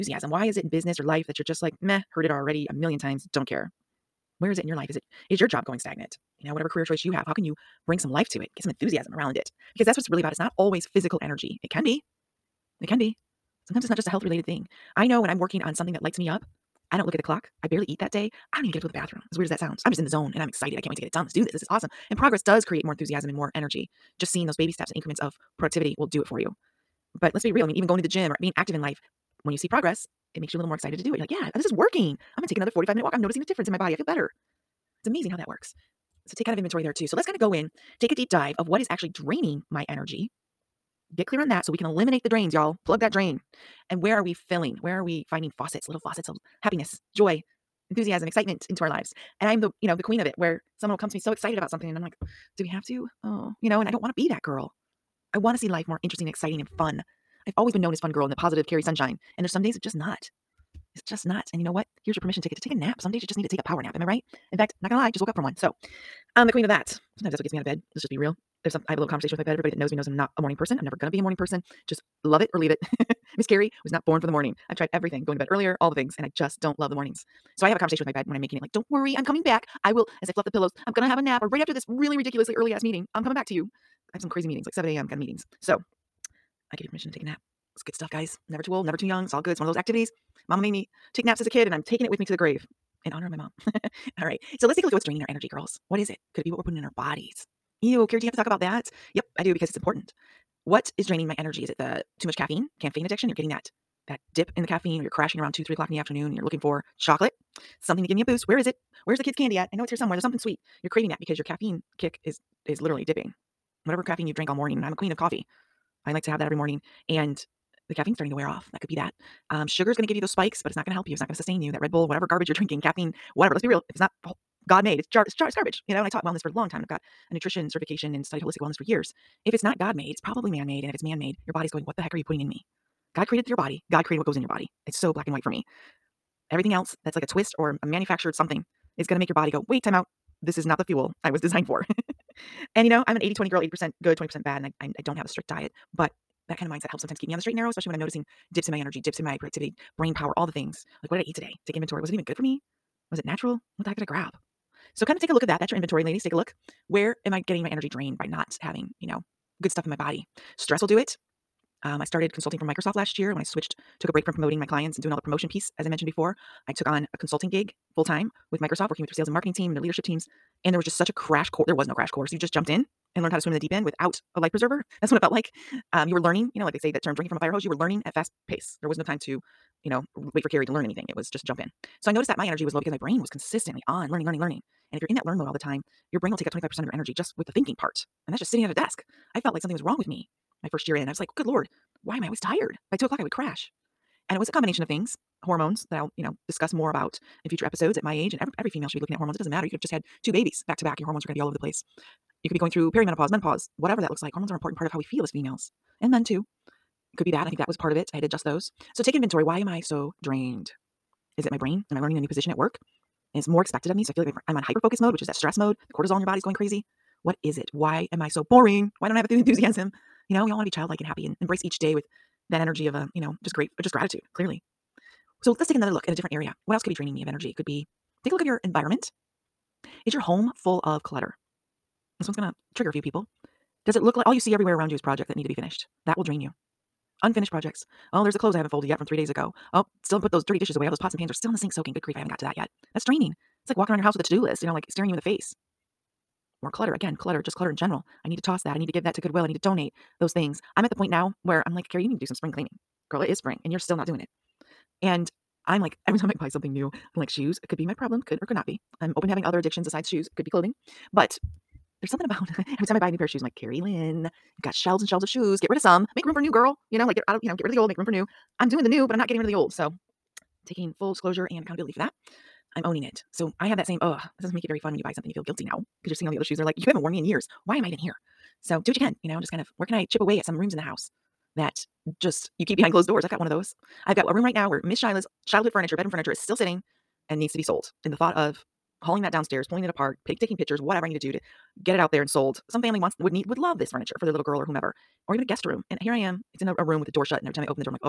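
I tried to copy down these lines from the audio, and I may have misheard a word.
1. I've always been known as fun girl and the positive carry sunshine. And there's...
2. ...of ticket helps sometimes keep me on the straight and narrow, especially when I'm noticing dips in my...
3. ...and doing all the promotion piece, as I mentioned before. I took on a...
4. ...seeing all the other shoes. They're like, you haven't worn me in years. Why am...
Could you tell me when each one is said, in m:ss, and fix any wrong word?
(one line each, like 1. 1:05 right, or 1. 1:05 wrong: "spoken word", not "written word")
1. 0:57 right
2. 2:26 wrong: "mindset", not "ticket"
3. 2:44 right
4. 4:36 right.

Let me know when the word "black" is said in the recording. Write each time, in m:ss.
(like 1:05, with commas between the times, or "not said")
2:15.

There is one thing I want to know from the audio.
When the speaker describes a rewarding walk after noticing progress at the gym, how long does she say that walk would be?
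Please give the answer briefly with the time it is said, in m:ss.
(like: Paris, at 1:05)
45 minutes, at 0:32.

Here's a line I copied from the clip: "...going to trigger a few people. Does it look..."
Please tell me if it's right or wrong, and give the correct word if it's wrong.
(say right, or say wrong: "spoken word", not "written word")
right.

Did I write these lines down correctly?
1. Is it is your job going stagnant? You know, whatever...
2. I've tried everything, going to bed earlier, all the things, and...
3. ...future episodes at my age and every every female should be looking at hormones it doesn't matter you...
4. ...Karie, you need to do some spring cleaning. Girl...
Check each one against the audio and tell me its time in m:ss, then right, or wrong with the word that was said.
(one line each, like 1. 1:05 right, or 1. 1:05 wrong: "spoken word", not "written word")
1. 0:04 right
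2. 1:14 right
3. 3:17 right
4. 4:11 right.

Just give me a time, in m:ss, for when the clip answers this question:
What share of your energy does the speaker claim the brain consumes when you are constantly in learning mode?
3:06.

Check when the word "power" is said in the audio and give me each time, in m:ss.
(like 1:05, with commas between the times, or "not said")
1:03, 2:30.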